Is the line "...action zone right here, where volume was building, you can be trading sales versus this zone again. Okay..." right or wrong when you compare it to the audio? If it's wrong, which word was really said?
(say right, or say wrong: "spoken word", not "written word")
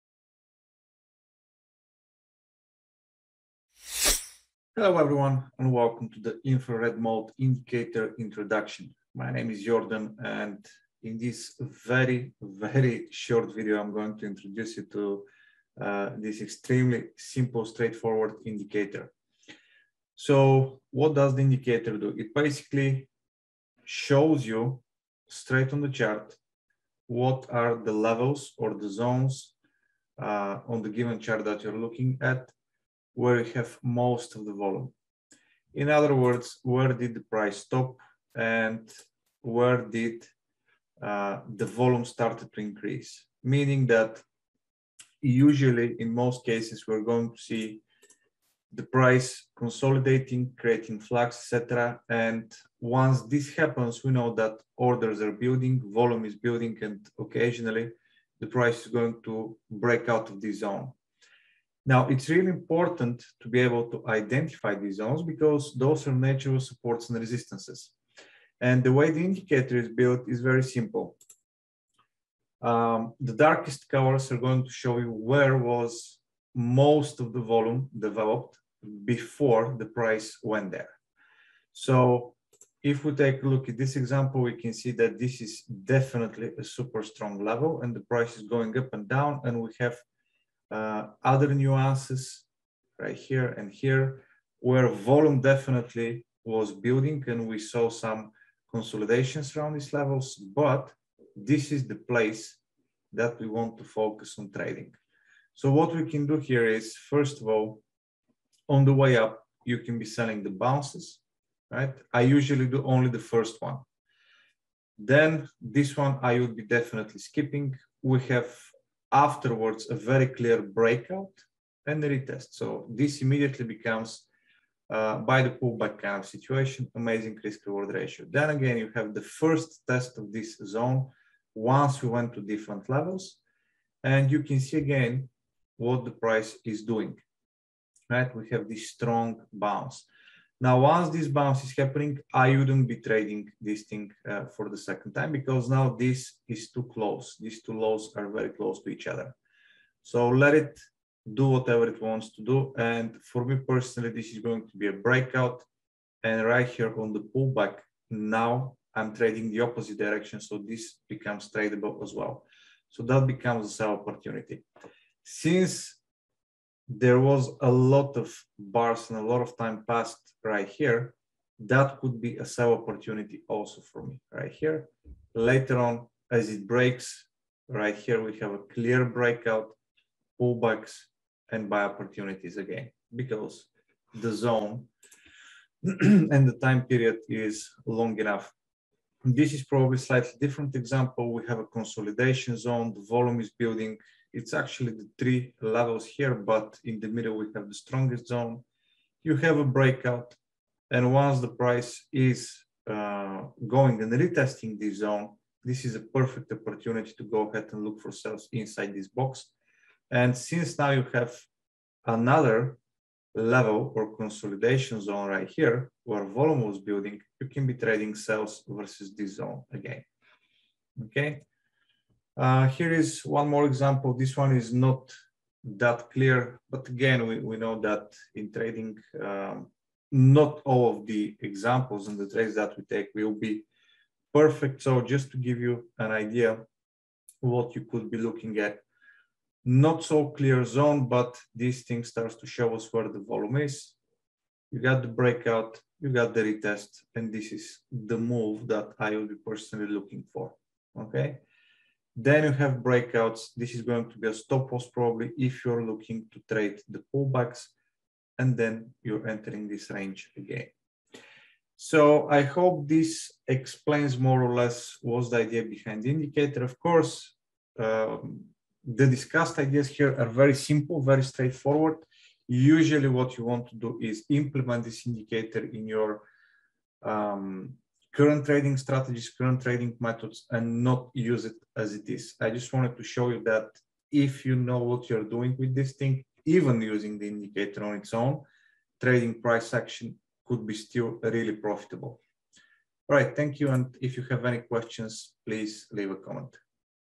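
wrong: "consolidation", not "action".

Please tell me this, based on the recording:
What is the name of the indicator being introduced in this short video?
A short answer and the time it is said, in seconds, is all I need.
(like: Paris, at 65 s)
Infrared mode indicator, at 6 s.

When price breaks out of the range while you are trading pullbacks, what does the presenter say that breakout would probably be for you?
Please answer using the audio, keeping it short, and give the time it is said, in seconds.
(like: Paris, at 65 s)
A stop loss, at 254 s.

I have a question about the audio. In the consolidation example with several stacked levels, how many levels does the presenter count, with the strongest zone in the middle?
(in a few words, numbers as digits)
3.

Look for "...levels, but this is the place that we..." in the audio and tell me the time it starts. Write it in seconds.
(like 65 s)
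99 s.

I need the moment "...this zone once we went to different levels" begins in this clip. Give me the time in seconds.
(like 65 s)
130 s.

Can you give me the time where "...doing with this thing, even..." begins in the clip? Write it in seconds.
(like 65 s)
285 s.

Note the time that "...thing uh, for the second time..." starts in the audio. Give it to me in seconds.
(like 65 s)
143 s.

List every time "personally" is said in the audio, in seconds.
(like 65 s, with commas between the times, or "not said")
153 s, 249 s.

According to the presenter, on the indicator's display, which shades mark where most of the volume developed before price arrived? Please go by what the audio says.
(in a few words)
The darkest colors.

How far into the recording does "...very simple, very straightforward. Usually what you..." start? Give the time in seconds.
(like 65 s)
270 s.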